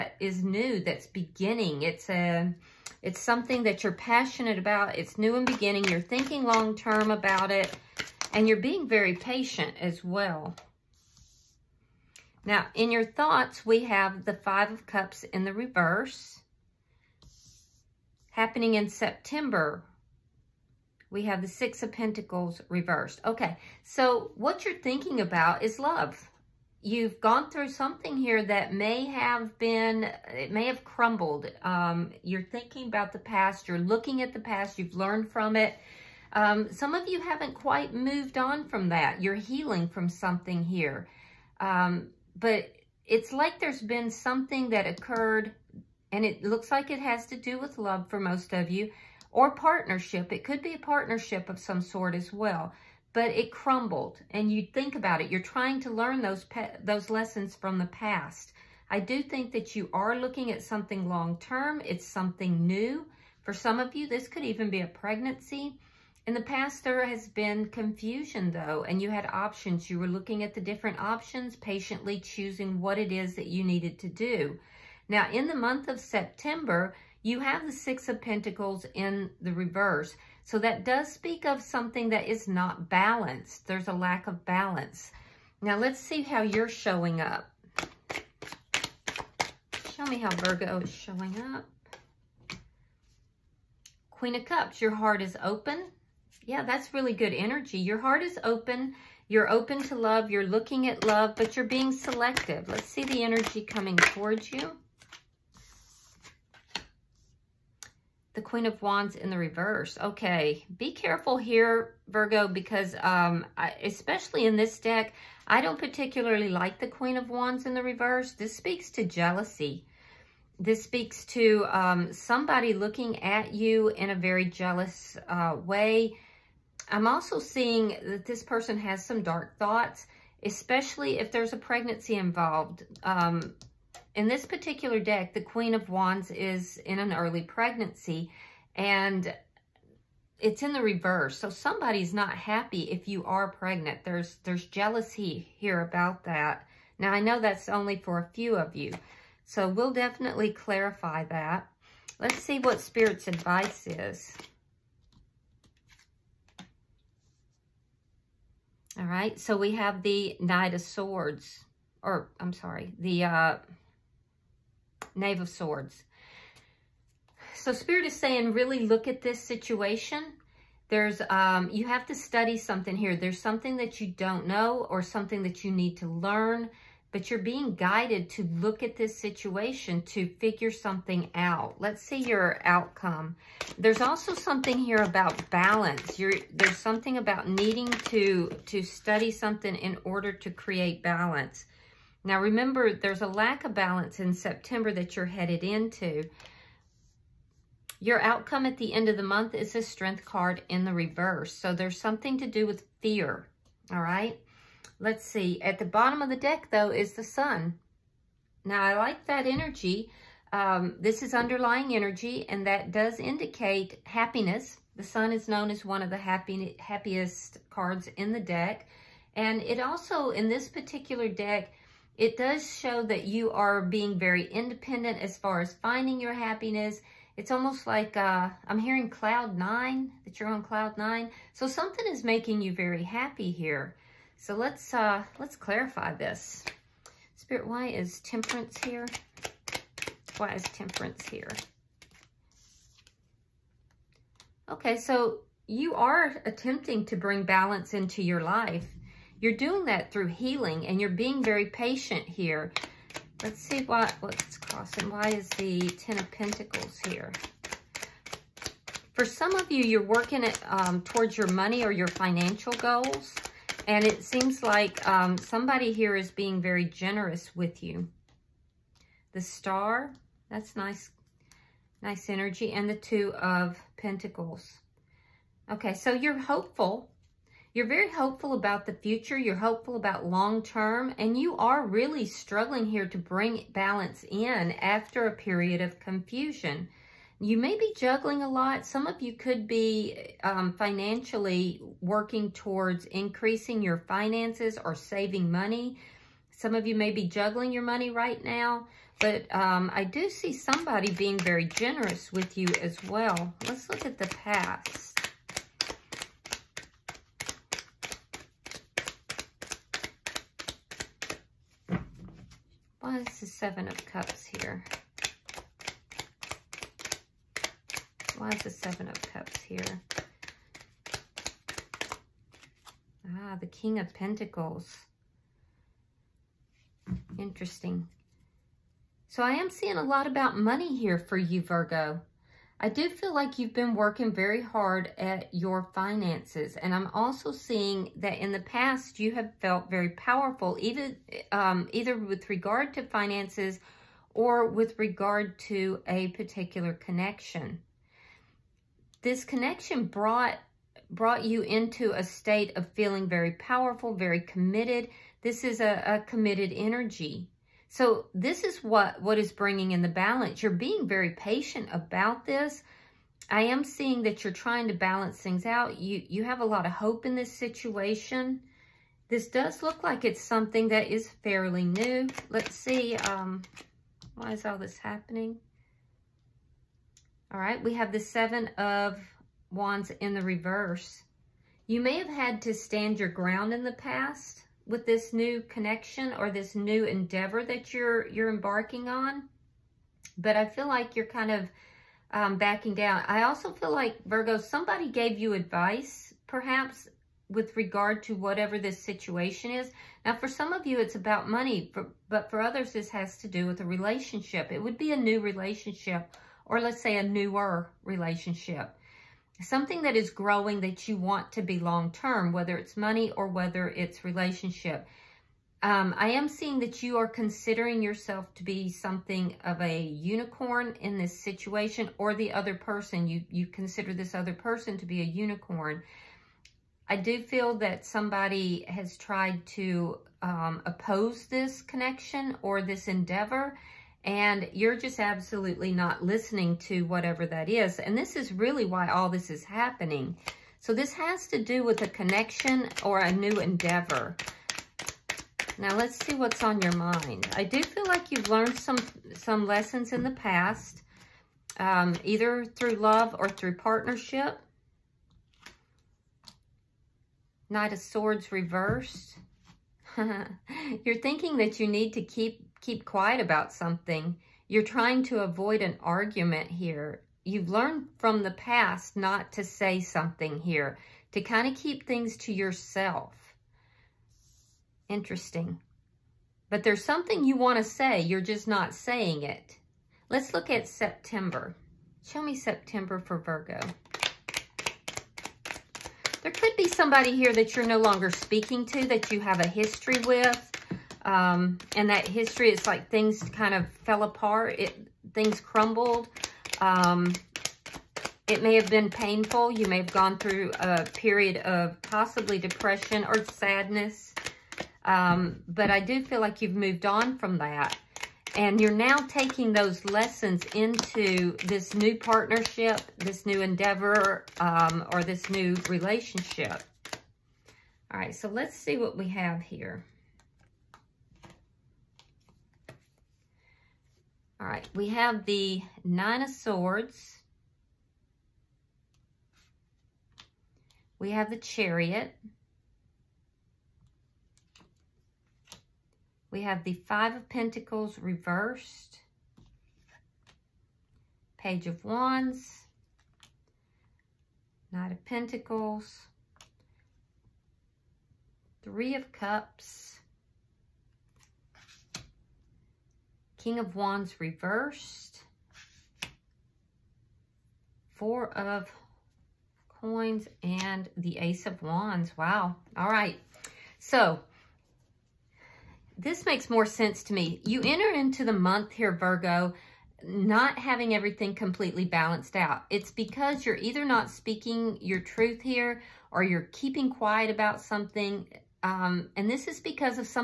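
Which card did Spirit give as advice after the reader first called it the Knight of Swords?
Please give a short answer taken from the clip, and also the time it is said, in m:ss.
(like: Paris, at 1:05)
Knave of Swords, at 2:45.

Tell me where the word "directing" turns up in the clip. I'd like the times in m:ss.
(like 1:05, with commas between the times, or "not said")
not said.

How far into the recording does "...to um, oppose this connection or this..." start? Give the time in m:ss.
7:09.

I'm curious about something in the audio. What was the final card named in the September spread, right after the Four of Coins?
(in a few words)
Ace of Wands.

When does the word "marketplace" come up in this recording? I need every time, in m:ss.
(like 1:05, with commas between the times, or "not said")
not said.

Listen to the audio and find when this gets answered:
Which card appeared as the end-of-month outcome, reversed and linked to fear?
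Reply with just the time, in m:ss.
3:19.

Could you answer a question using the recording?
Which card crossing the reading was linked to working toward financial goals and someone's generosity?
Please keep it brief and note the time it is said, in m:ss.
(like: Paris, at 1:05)
Ten of Pentacles, at 4:15.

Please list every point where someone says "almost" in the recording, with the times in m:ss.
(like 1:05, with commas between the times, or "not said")
3:47.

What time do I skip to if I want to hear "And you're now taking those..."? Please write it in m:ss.
8:28.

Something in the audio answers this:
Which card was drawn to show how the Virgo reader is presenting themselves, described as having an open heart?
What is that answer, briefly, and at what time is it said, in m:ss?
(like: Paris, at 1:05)
Queen of Cups, at 1:34.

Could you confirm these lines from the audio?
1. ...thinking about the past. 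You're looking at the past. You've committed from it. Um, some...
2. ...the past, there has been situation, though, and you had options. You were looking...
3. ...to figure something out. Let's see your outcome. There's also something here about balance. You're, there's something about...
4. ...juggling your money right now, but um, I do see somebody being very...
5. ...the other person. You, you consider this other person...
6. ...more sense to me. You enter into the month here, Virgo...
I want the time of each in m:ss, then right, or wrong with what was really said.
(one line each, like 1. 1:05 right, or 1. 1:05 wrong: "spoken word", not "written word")
1. 0:32 wrong: "learned", not "committed"
2. 1:06 wrong: "confusion", not "situation"
3. 3:00 right
4. 4:57 right
5. 7:02 right
6. 9:26 right.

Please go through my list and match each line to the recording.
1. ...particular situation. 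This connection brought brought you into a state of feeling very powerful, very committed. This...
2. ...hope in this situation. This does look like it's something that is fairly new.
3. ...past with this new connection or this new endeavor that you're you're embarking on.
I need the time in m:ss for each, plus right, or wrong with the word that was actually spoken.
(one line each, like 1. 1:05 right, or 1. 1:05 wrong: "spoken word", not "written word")
1. 5:46 wrong: "connection", not "situation"
2. 6:06 right
3. 6:23 right.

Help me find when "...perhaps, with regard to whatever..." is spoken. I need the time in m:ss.
6:36.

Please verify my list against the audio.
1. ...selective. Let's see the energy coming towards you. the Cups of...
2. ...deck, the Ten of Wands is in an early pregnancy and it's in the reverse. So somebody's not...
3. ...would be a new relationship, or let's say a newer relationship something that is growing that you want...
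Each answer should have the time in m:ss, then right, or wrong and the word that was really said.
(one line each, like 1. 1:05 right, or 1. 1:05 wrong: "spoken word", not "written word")
1. 1:41 wrong: "Queen", not "Cups"
2. 2:15 wrong: "Queen", not "Ten"
3. 6:44 right.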